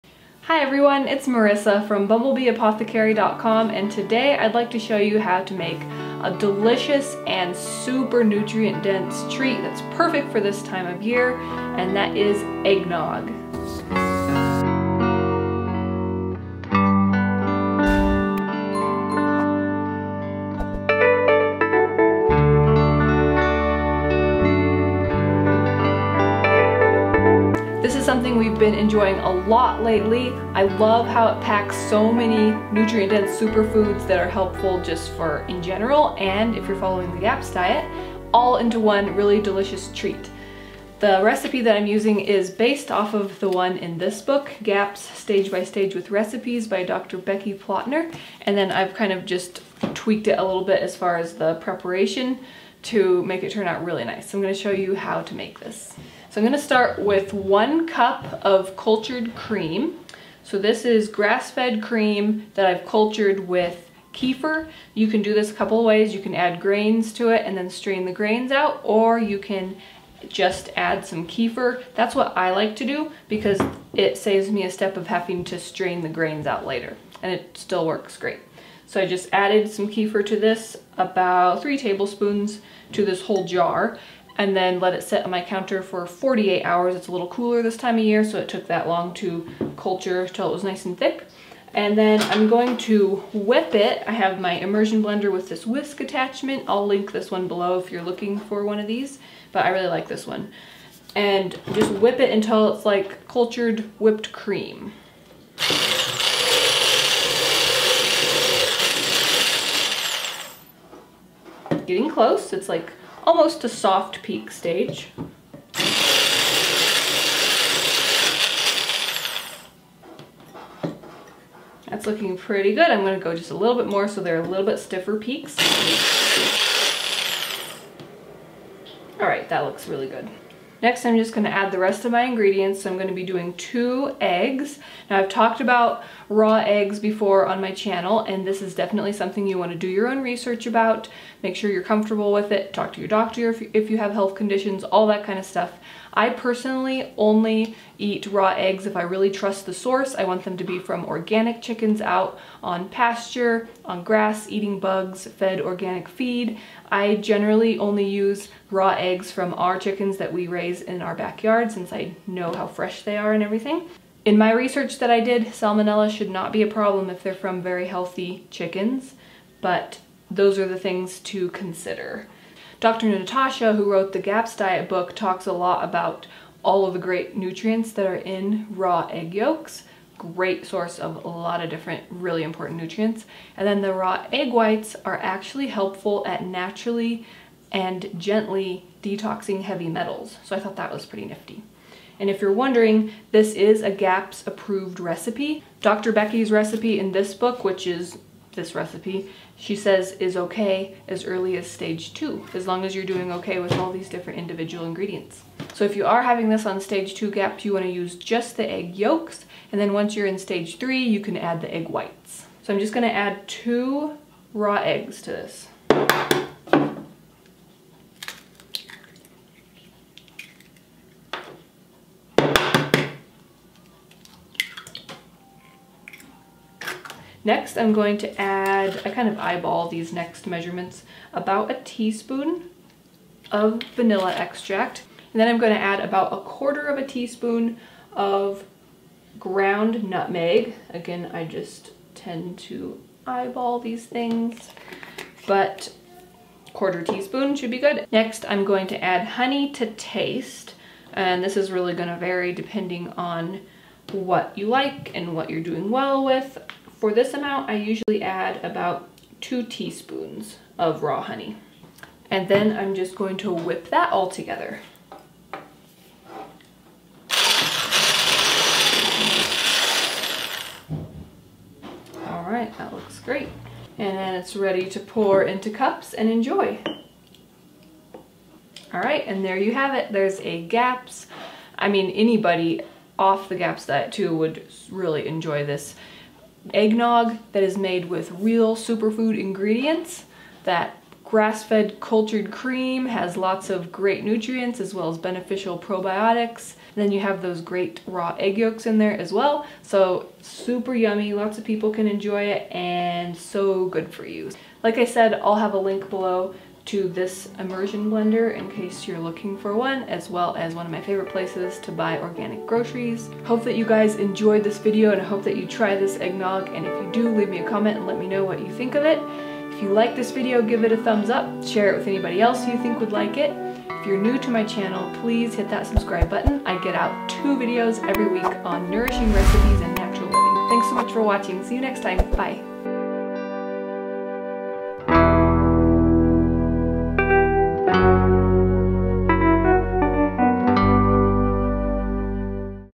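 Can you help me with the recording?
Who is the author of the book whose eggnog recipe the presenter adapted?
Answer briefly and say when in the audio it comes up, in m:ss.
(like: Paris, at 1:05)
Dr. Becky Plotner, at 0:46.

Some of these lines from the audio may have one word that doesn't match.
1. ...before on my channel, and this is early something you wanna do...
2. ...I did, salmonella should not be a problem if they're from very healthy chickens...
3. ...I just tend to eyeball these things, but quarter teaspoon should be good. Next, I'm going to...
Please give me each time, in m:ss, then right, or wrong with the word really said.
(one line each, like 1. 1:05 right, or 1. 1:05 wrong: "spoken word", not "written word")
1. 2:16 wrong: "definitely", not "early"
2. 2:45 right
3. 4:01 right.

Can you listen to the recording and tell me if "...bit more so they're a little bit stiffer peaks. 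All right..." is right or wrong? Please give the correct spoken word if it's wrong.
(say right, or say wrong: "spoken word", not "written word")
right.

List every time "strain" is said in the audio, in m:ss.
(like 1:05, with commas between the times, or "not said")
1:07, 1:15.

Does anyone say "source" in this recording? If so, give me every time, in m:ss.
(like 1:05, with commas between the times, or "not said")
2:29, 3:00.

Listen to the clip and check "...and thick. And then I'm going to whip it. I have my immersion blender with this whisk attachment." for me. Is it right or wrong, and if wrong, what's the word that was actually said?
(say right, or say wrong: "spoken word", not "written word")
right.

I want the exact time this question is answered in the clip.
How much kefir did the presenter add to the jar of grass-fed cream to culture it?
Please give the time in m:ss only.
1:20.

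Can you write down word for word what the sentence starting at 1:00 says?
So this is grass-fed cream that I've cultured with kefir.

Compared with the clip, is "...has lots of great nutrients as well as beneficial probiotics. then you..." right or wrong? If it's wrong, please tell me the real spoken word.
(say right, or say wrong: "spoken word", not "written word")
right.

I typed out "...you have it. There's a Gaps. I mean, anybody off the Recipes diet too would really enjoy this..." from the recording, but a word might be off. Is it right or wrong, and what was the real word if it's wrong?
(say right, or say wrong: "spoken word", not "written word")
wrong: "Gaps", not "Recipes".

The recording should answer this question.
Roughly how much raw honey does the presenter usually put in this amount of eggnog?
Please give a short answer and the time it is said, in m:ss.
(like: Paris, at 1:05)
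2 teaspoons, at 4:18.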